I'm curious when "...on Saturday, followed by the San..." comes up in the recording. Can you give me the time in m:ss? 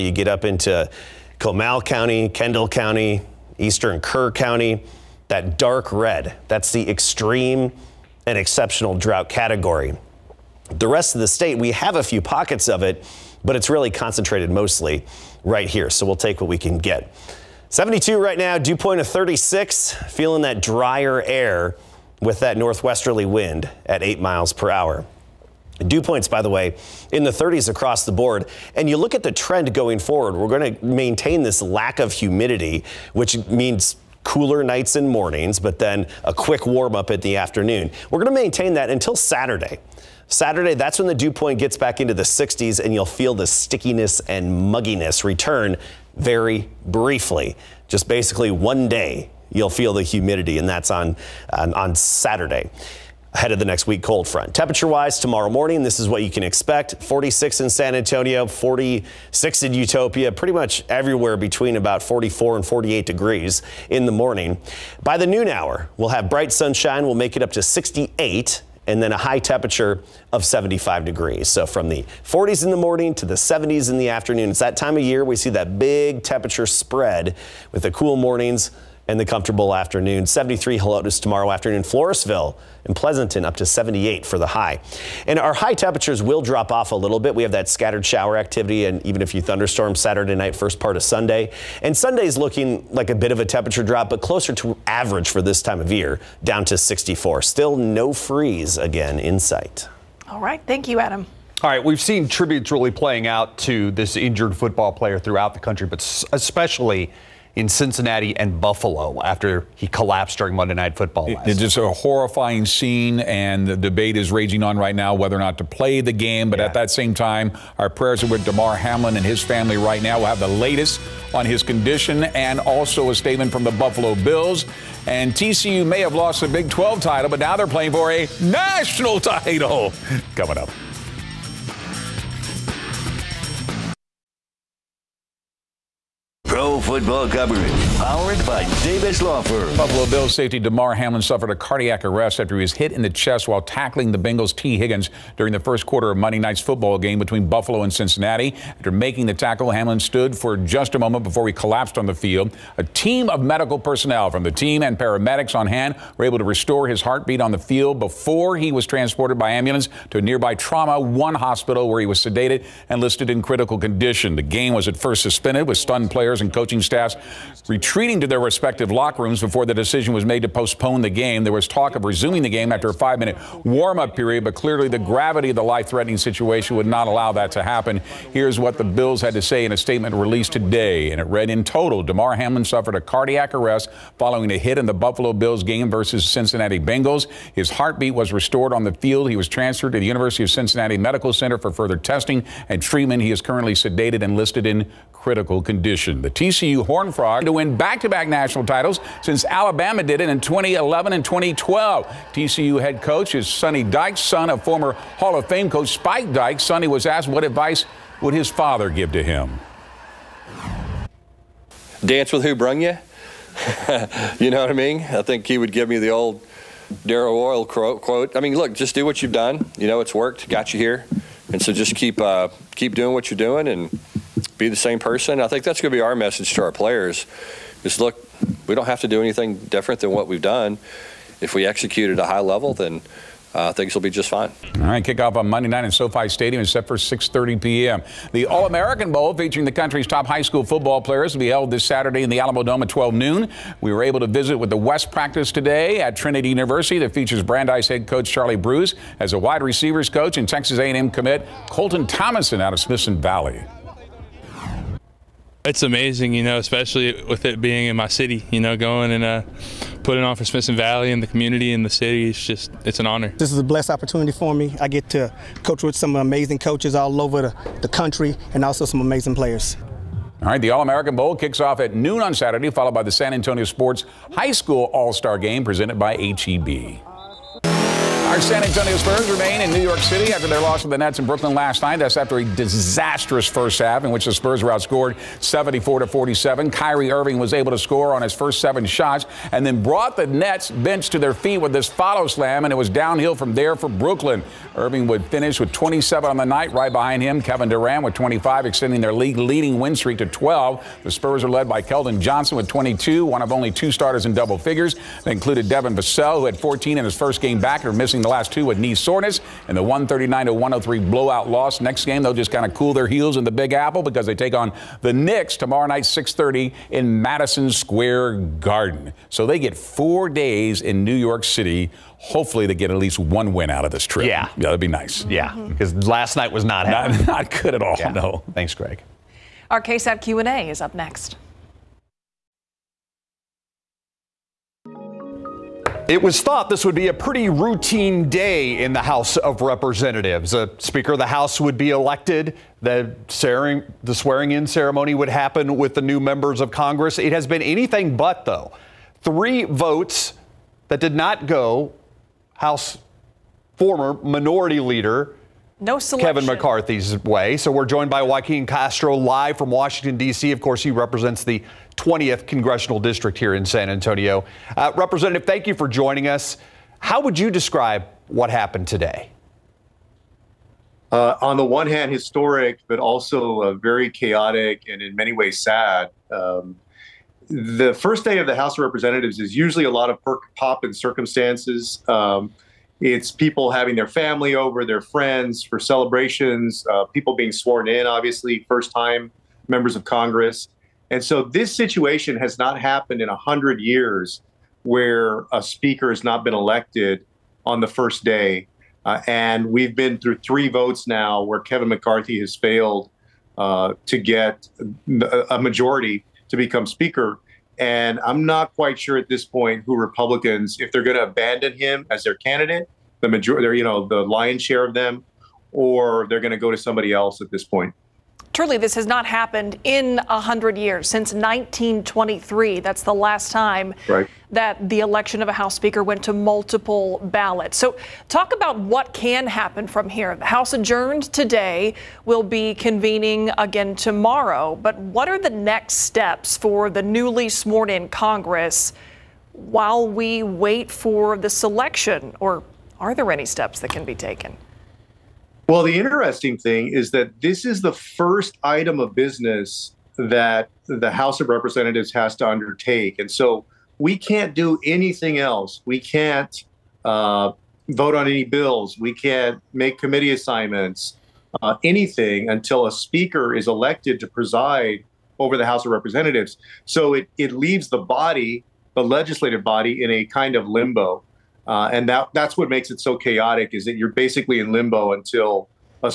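4:32.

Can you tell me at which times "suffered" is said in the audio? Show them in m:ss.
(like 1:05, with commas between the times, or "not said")
2:21, 3:02.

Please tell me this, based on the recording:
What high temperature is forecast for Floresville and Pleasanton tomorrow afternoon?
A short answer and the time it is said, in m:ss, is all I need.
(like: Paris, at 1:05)
78, at 1:23.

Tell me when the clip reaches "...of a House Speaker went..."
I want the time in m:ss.
7:05.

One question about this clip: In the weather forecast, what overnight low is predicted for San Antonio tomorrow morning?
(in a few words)
46.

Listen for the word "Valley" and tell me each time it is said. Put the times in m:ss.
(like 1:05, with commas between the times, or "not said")
4:13, 4:20.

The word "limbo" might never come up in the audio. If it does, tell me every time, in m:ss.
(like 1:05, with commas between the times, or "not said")
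7:50, 7:54.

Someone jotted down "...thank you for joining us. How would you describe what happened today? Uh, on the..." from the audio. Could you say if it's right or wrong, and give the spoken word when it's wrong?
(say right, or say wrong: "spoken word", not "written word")
right.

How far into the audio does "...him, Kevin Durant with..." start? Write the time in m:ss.
4:57.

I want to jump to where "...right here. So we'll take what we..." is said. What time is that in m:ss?
0:15.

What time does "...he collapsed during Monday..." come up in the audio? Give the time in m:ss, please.
1:49.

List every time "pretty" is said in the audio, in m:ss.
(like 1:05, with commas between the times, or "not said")
1:00, 5:37.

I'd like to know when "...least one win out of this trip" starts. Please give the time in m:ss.
5:22.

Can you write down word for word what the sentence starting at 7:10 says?
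The House adjourned today, will be convening again tomorrow.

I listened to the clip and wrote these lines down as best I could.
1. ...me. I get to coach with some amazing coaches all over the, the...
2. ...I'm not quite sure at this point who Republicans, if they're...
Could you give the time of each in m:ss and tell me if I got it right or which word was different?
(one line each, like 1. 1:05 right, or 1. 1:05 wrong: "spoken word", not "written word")
1. 4:24 right
2. 6:48 right.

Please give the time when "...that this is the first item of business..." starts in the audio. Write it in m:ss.
7:27.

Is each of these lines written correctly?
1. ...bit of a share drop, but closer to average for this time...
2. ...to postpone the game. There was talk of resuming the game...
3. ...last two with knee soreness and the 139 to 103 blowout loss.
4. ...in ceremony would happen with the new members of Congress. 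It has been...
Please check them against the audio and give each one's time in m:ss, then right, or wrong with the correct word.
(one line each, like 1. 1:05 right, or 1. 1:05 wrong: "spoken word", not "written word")
1. 1:33 wrong: "temperature", not "share"
2. 2:50 right
3. 5:08 right
4. 5:44 right.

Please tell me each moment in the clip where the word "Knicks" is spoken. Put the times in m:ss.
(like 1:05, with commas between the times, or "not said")
5:15.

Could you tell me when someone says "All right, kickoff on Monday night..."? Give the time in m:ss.
3:54.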